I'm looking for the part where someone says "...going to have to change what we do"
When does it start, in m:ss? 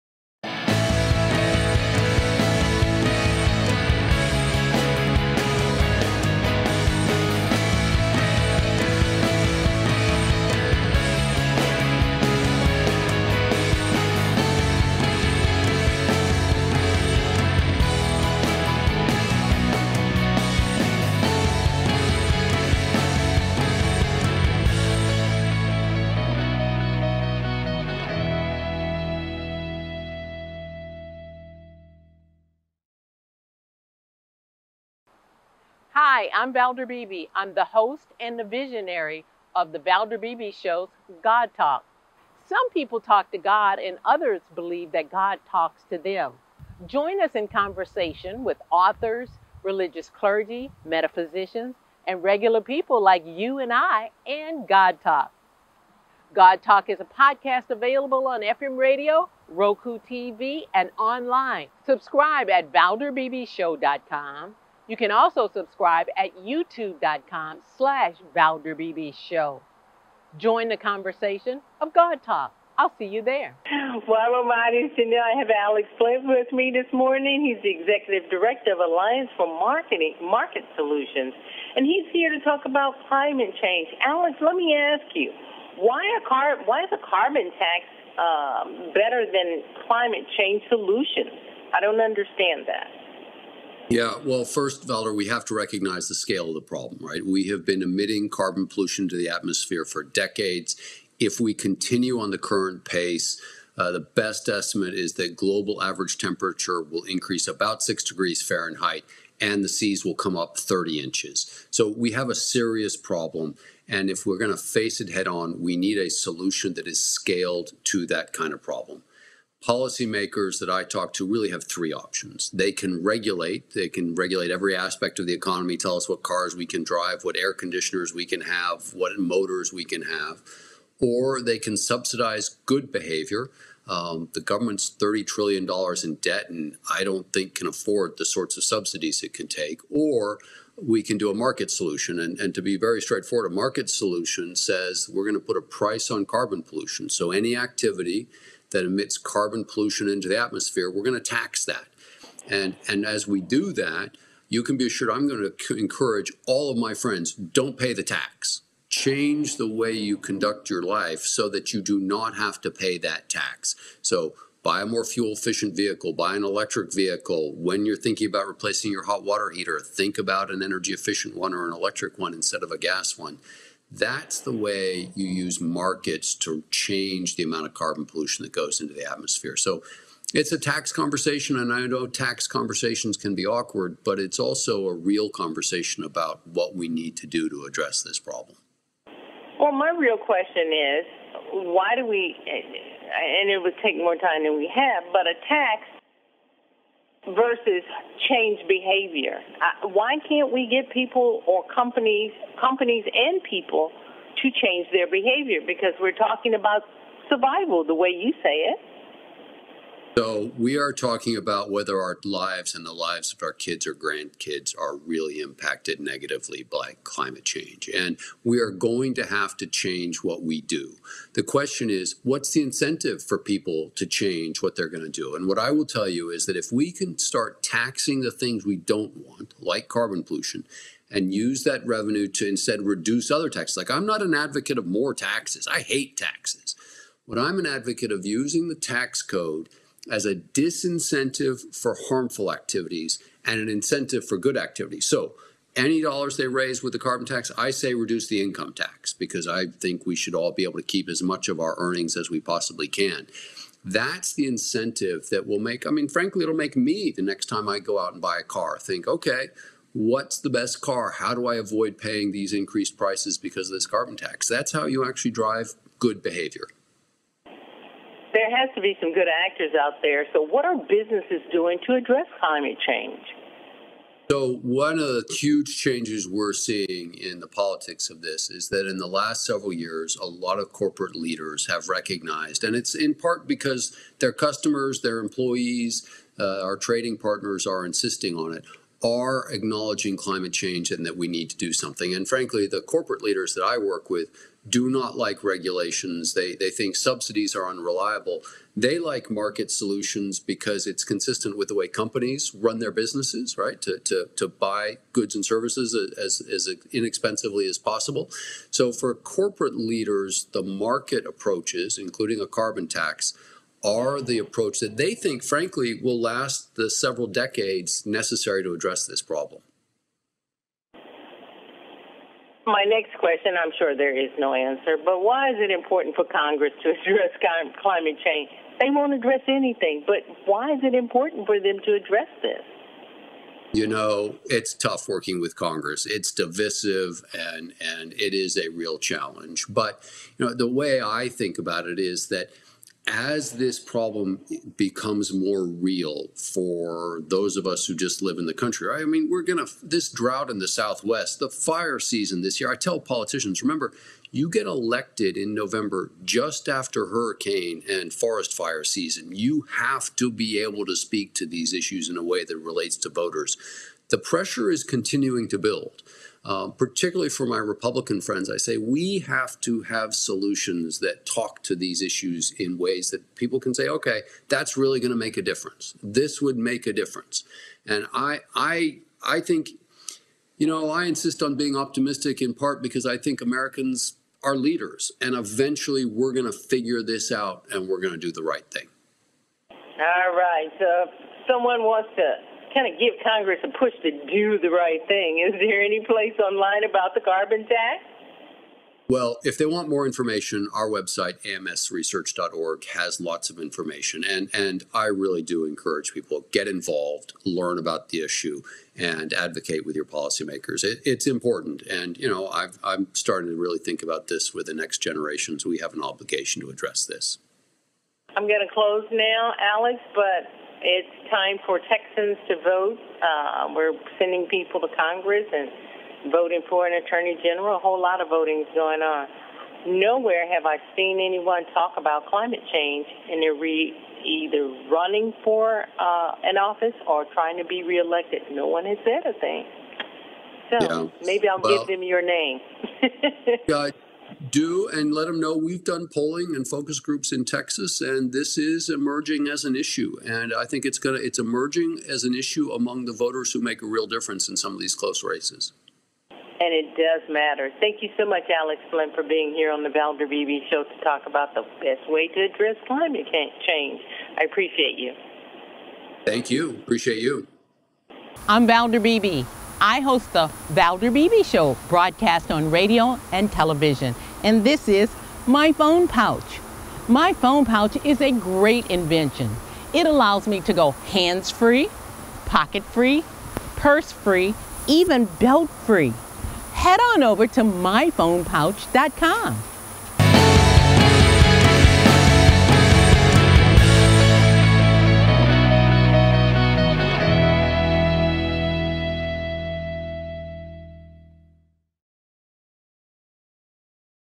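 3:38.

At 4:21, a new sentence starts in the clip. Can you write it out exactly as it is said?
How do I avoid paying these increased prices because of this carbon tax?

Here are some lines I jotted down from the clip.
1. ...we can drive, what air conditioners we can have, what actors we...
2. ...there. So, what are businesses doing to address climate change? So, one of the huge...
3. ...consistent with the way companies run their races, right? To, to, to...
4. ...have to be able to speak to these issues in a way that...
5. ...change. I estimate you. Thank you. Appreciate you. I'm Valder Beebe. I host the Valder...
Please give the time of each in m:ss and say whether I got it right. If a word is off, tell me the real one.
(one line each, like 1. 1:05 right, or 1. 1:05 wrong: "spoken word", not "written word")
1. 2:06 wrong: "motors", not "actors"
2. 4:30 right
3. 5:01 wrong: "businesses", not "races"
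4. 5:59 right
5. 7:43 wrong: "appreciate", not "estimate".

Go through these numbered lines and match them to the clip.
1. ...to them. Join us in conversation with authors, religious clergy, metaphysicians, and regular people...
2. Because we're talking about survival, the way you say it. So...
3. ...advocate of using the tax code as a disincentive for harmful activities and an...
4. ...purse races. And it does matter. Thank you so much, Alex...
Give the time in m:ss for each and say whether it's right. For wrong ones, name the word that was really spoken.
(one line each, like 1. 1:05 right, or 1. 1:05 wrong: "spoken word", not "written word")
1. 0:45 right
2. 3:25 right
3. 3:57 right
4. 7:34 wrong: "close", not "purse".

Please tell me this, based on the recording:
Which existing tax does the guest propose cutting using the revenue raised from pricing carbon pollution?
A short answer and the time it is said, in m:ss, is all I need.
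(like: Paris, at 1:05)
Income tax, at 4:08.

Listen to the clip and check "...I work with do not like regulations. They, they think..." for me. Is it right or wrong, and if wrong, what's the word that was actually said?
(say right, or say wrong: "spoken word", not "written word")
right.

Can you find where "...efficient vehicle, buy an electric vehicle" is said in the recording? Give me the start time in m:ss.
2:45.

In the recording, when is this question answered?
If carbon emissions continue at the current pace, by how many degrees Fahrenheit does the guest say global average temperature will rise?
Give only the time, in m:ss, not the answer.
1:47.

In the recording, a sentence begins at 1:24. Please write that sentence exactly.
Alex, let me ask you, why, a car, why is a carbon tax um, better than climate change solutions?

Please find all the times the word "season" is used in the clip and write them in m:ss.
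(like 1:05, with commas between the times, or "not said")
5:51, 5:58.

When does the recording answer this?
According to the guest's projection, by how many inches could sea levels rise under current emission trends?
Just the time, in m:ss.
1:50.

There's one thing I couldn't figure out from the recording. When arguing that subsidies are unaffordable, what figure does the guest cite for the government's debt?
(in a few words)
$30 trillion.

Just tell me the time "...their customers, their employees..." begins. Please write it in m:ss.
4:44.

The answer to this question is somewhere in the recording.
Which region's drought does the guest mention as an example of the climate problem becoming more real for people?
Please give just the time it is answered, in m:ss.
5:50.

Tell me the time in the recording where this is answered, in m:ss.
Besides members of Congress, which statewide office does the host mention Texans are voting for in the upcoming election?
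7:07.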